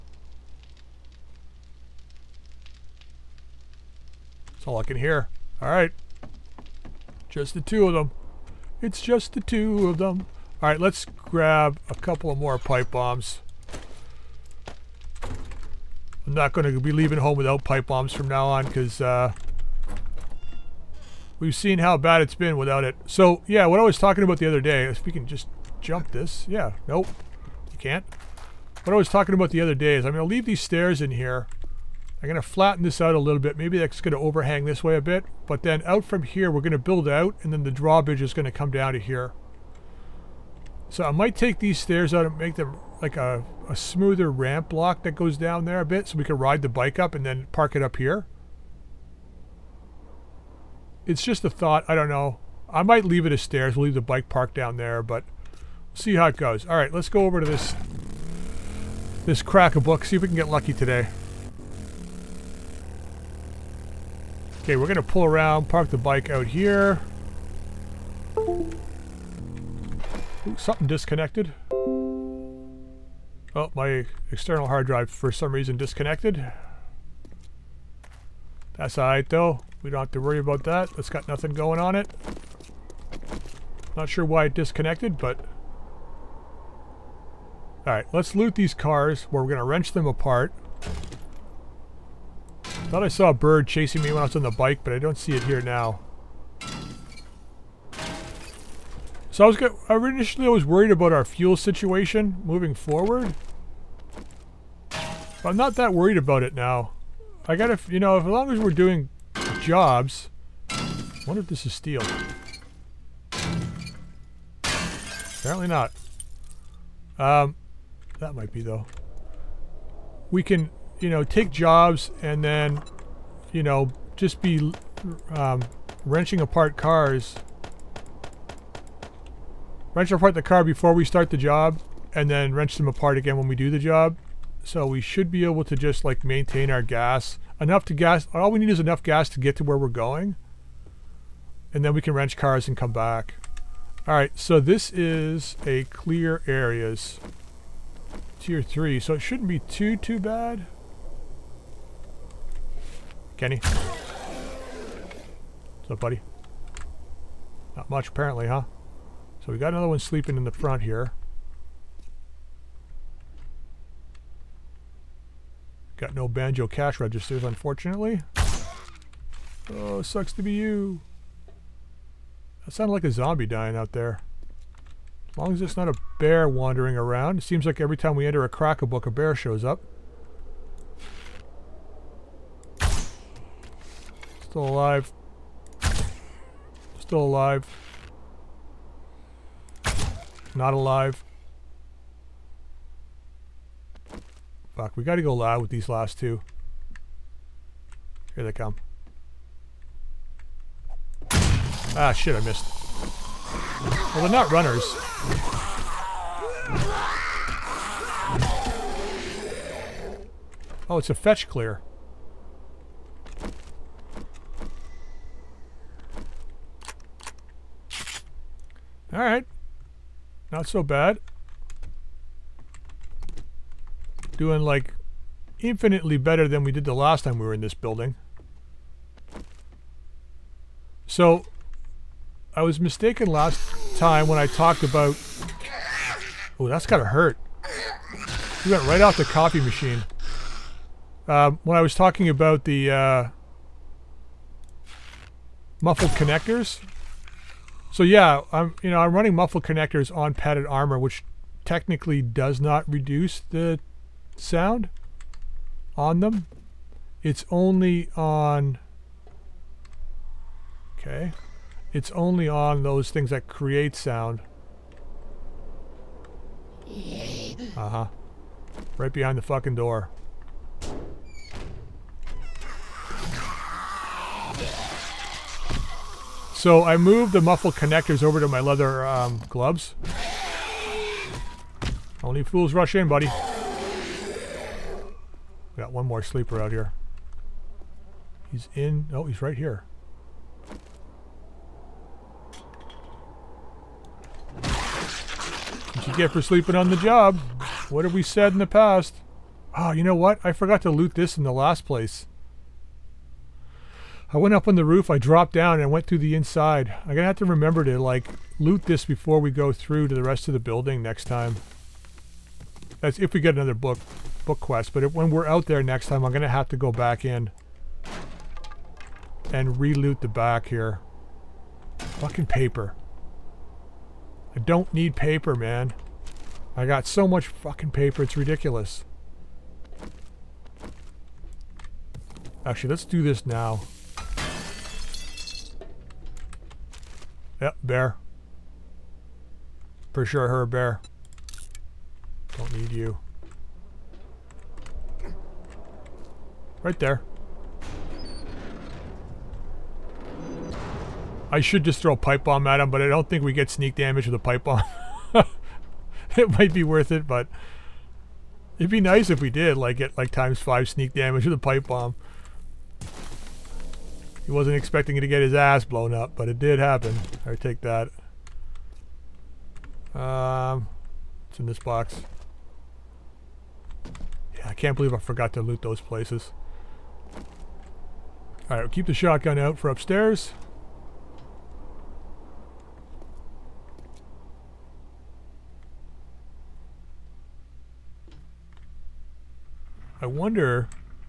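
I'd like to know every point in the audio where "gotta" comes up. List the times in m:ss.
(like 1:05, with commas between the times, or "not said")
1:47, 3:15, 3:56.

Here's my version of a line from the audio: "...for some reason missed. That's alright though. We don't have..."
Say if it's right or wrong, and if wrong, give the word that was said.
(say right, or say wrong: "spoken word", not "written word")
wrong: "disconnected", not "missed".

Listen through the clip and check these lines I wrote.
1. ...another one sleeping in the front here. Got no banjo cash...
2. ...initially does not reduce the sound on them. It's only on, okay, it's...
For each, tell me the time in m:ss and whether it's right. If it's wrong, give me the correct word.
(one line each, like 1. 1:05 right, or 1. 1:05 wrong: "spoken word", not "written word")
1. 2:39 right
2. 4:11 wrong: "technically", not "initially".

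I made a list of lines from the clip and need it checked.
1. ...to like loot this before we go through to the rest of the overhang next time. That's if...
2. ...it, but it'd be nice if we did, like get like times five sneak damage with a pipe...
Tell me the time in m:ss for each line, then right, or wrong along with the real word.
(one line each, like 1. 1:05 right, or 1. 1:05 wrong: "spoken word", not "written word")
1. 5:07 wrong: "building", not "overhang"
2. 5:57 right.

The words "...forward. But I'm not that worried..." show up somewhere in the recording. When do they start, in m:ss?
1:42.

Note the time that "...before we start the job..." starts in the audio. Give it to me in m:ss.
2:10.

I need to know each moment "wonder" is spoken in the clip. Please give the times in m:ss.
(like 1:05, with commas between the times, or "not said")
1:51, 6:30.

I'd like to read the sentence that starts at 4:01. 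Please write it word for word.
Um, when I was talking about the uh, muffled connectors.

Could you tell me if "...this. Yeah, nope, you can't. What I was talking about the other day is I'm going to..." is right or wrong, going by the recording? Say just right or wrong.
right.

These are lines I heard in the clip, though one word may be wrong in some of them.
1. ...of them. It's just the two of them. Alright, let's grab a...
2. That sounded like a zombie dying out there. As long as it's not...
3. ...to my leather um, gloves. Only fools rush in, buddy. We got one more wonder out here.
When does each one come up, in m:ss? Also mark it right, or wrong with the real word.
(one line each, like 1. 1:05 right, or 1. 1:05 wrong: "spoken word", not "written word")
1. 0:07 right
2. 2:52 right
3. 4:38 wrong: "sleeper", not "wonder".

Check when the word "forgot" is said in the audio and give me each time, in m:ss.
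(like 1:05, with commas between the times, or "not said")
5:00, 6:15.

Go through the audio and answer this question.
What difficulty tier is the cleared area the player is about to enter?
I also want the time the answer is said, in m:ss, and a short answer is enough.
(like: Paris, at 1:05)
Tier 3, at 2:28.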